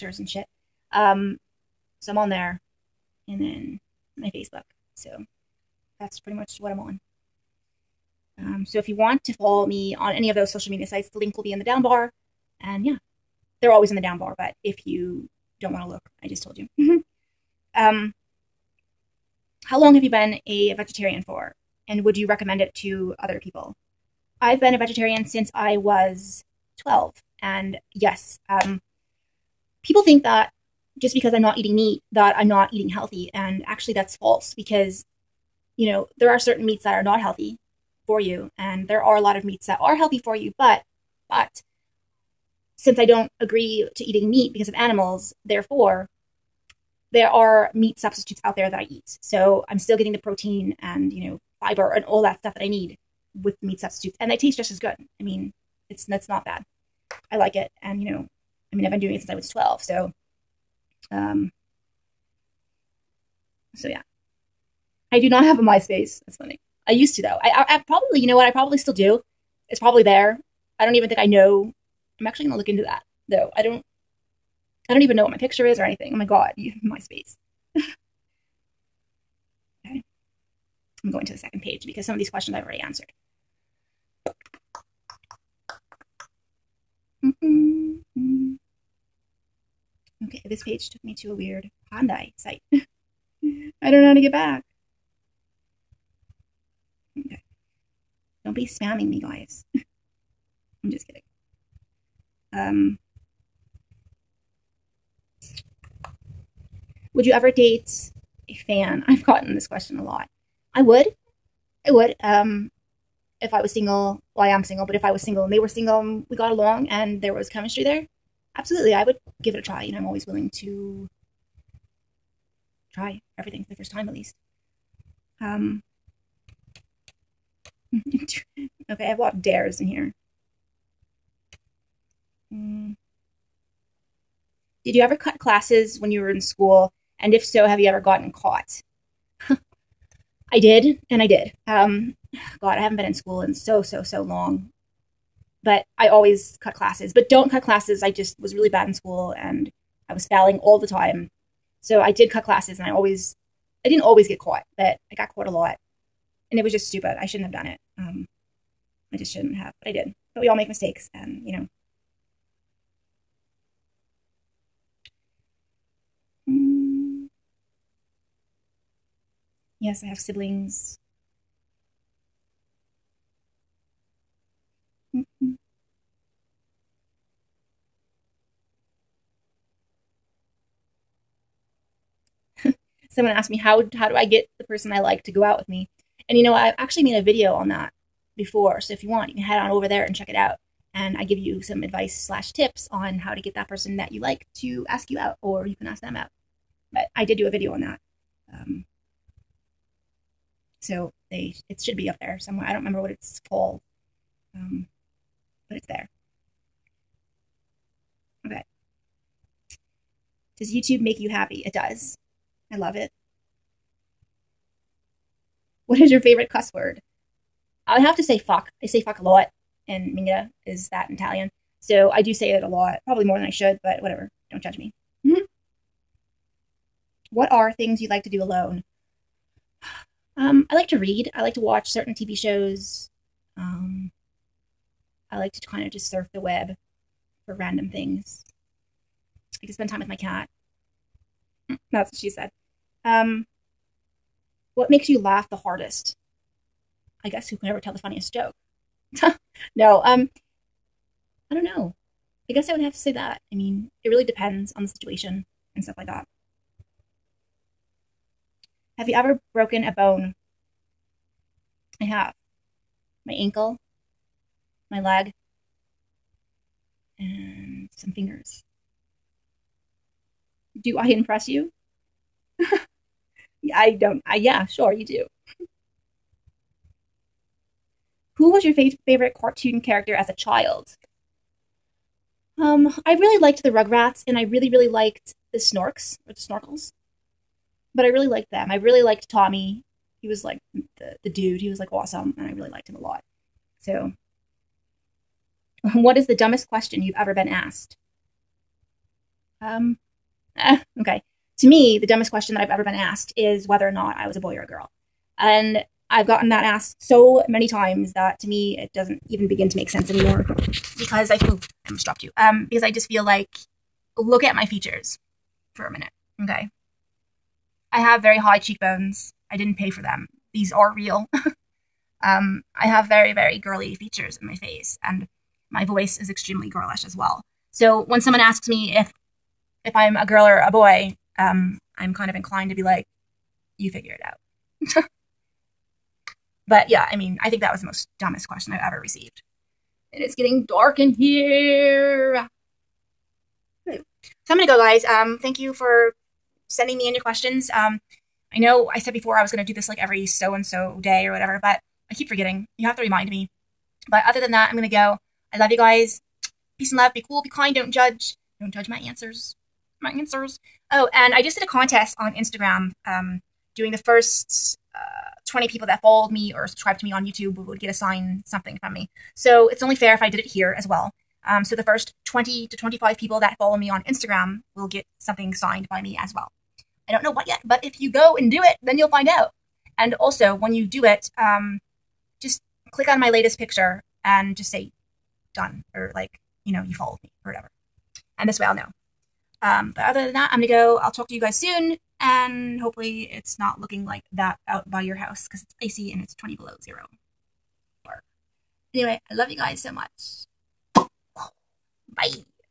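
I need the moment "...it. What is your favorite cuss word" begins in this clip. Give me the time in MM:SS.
03:32.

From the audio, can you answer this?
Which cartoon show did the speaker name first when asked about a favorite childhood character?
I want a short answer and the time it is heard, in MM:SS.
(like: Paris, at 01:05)
Rugrats, at 04:43.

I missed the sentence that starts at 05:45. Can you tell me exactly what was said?
Um, thank you for sending me in your questions.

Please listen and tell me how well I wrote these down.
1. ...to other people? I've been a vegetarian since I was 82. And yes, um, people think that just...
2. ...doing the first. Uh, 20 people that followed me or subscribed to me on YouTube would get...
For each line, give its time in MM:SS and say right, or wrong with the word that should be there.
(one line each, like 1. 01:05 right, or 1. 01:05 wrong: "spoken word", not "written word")
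1. 00:22 wrong: "12", not "82"
2. 06:03 right.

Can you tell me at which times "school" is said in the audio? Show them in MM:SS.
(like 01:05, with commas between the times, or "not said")
02:16, 02:23, 02:28.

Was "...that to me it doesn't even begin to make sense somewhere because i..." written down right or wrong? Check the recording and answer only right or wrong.
wrong.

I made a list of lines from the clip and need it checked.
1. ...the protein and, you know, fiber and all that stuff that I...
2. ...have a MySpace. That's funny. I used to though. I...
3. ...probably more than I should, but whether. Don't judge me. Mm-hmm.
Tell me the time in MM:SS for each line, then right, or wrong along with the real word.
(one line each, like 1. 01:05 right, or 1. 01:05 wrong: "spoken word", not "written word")
1. 00:50 right
2. 01:05 right
3. 03:43 wrong: "whatever", not "whether".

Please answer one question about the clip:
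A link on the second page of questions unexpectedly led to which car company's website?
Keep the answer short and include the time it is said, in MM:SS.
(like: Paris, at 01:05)
Hyundai, at 01:31.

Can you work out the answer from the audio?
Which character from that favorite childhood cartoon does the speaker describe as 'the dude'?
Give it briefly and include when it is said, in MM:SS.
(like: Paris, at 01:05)
Tommy, at 04:49.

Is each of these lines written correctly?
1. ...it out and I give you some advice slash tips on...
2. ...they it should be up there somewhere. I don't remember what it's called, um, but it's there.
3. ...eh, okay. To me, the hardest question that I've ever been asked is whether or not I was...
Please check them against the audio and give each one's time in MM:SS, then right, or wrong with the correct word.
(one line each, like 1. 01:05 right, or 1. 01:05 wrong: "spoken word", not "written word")
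1. 03:10 right
2. 03:21 right
3. 05:00 wrong: "dumbest", not "hardest".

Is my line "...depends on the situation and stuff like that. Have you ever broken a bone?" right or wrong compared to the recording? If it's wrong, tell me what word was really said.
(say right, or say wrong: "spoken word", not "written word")
right.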